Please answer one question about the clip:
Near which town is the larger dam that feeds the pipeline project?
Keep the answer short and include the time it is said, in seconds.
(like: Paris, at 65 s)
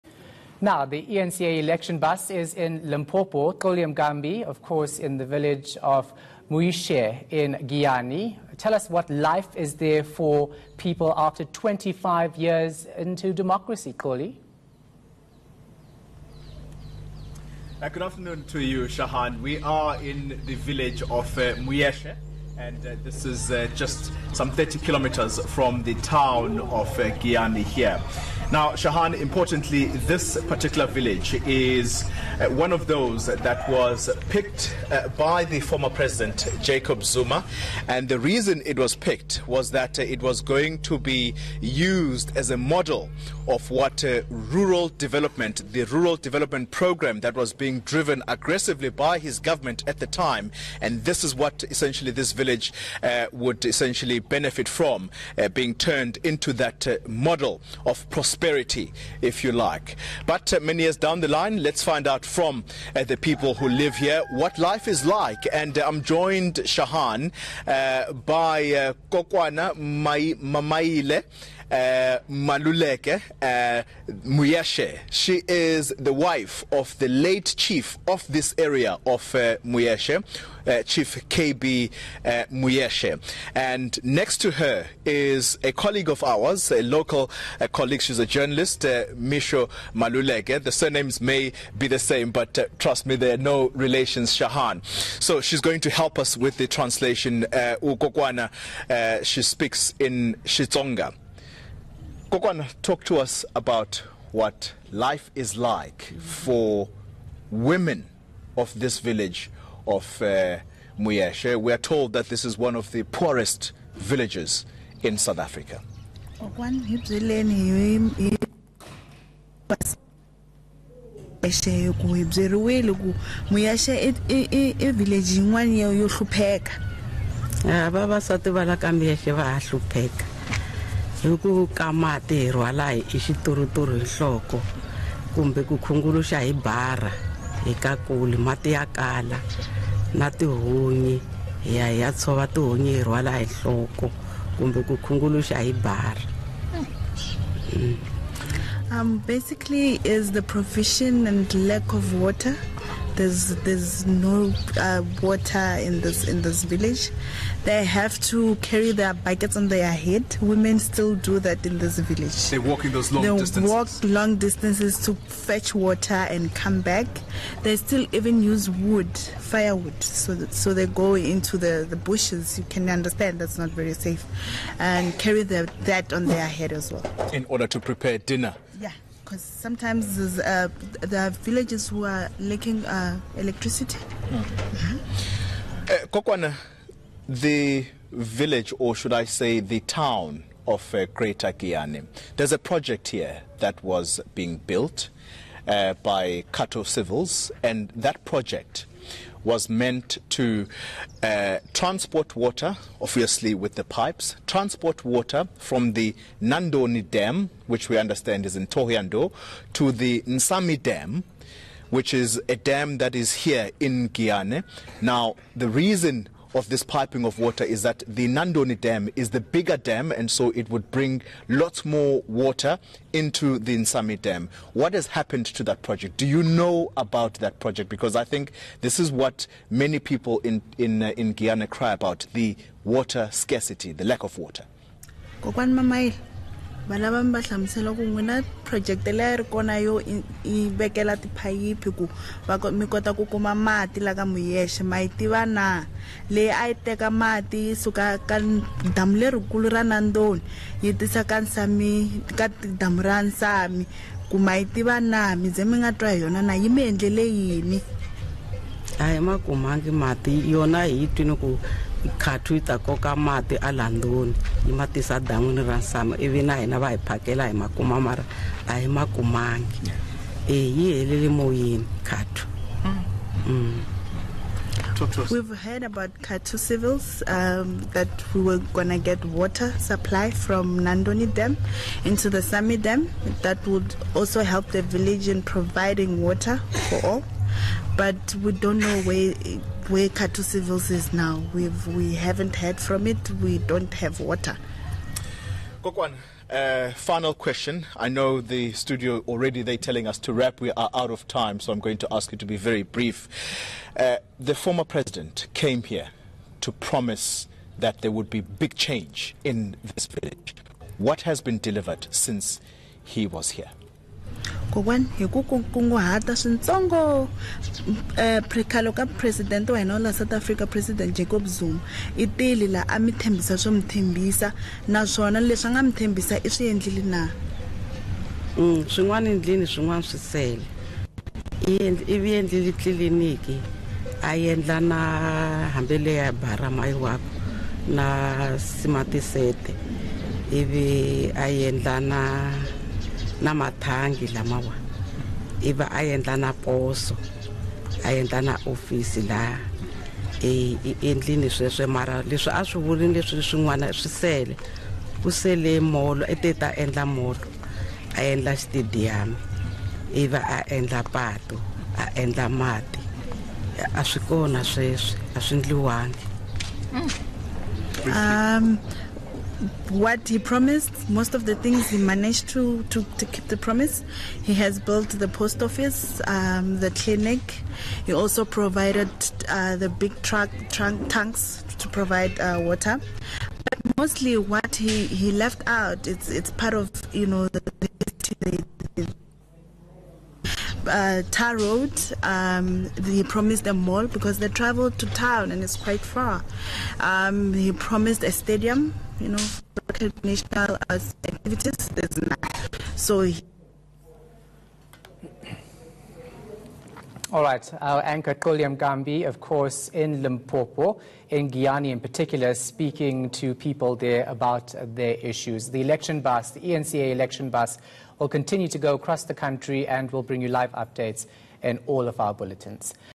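Thohoyandou, at 208 s.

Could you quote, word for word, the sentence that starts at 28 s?
Now, Shahan, importantly, this particular village is uh, one of those that was picked uh, by the former president, Jacob Zuma.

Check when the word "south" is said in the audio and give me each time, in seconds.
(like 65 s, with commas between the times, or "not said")
115 s, 320 s.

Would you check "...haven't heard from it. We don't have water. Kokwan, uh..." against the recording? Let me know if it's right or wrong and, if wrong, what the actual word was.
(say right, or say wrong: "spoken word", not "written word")
right.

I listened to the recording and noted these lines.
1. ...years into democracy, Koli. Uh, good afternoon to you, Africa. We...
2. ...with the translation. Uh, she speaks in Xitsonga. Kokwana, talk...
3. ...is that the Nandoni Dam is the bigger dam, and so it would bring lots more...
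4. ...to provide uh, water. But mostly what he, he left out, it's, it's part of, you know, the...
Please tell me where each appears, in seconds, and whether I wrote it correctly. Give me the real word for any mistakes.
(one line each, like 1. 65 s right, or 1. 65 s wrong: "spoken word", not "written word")
1. 12 s wrong: "Shahan", not "Africa"
2. 96 s right
3. 217 s right
4. 381 s right.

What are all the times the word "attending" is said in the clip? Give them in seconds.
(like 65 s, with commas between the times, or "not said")
not said.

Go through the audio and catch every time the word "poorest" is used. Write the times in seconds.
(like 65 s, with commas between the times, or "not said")
113 s.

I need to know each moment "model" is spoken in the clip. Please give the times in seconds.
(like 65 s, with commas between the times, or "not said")
42 s, 57 s.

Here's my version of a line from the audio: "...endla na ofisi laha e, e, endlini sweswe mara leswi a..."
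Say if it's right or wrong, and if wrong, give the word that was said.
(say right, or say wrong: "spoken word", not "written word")
right.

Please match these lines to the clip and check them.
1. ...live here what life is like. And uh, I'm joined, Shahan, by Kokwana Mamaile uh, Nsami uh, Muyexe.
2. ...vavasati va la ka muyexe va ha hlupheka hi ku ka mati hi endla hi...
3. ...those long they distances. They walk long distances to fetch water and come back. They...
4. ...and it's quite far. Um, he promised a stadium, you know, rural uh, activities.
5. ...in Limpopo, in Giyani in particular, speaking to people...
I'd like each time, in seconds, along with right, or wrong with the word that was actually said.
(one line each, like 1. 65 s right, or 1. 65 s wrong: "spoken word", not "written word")
1. 63 s wrong: "Maluleke", not "Nsami"
2. 127 s wrong: "rhwala", not "endla"
3. 162 s right
4. 395 s wrong: "recreational", not "rural"
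5. 409 s right.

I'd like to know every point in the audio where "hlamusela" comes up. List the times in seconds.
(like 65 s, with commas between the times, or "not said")
237 s.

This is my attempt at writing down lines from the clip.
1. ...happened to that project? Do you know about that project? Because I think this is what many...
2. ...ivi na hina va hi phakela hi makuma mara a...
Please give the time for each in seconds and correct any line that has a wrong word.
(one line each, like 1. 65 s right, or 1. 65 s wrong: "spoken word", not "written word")
1. 225 s right
2. 266 s right.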